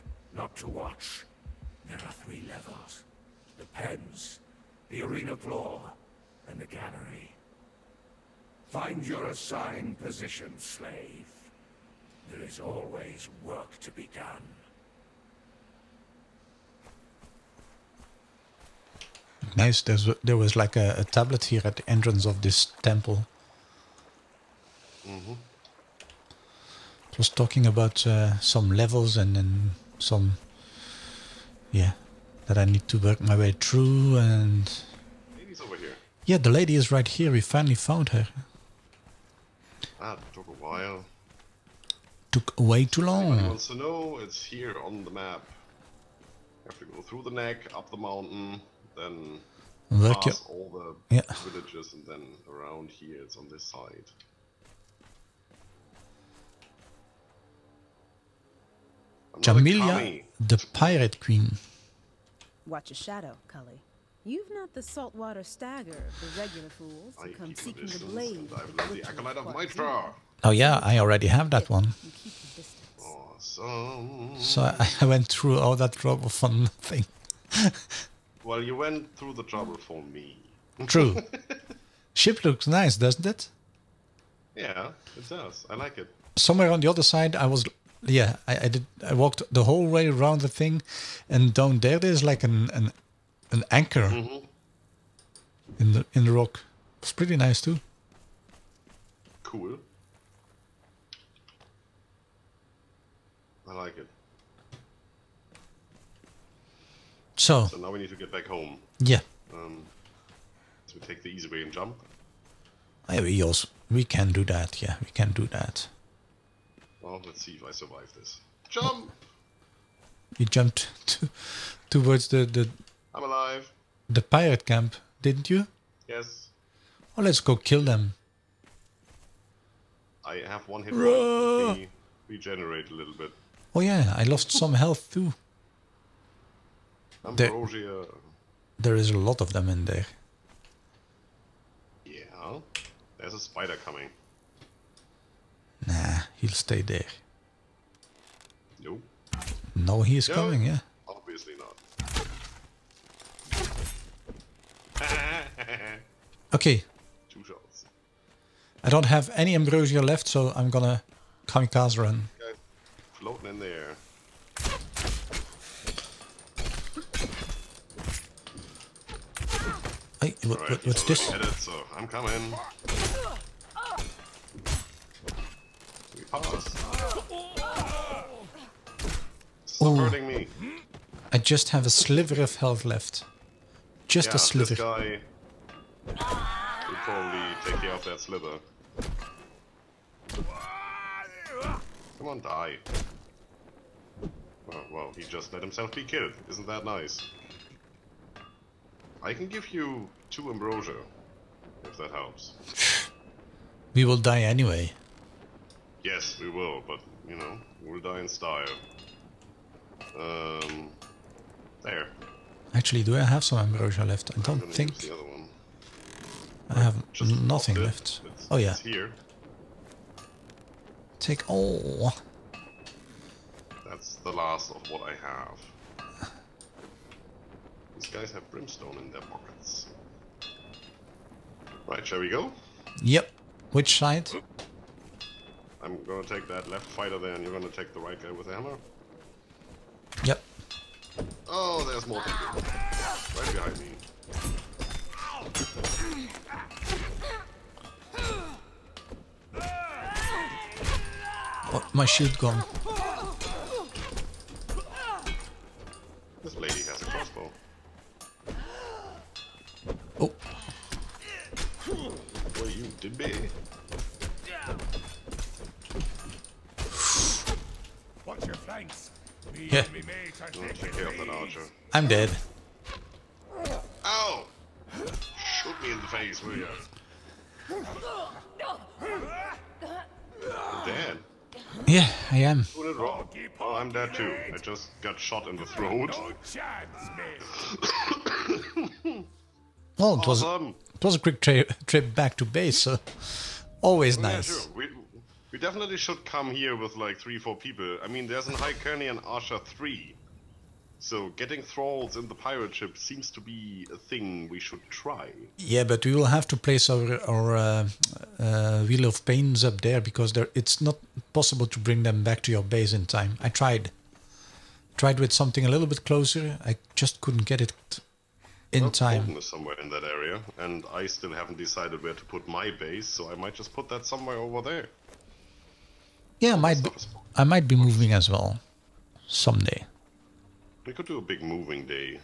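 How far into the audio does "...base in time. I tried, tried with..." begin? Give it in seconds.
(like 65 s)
312 s.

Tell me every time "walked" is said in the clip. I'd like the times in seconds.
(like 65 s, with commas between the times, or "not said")
89 s.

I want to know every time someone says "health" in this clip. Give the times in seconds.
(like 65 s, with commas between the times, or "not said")
134 s, 182 s.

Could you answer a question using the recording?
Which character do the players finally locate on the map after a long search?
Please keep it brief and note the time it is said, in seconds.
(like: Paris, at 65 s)
Jamila, the pirate queen, at 59 s.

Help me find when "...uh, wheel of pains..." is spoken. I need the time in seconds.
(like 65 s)
308 s.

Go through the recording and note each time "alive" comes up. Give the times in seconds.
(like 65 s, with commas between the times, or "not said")
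123 s.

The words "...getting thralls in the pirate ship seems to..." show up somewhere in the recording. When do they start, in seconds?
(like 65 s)
301 s.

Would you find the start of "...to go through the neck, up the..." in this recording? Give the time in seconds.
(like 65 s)
46 s.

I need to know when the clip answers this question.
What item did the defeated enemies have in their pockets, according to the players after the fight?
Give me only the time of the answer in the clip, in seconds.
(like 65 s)
228 s.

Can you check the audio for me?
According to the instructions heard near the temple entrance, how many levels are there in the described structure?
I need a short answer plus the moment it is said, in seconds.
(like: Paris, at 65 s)
3, at 2 s.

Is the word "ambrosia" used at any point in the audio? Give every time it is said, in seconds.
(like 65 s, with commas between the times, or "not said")
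137 s, 159 s, 200 s, 213 s.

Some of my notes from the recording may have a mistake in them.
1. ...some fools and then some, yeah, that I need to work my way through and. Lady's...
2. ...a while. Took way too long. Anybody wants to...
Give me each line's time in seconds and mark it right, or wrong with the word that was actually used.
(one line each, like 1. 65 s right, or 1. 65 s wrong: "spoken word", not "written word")
1. 28 s wrong: "levels", not "fools"
2. 40 s right.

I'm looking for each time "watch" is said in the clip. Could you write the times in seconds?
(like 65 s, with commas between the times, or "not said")
0 s, 62 s.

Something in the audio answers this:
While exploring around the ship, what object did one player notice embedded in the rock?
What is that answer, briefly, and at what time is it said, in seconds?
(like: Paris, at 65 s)
An anchor, at 93 s.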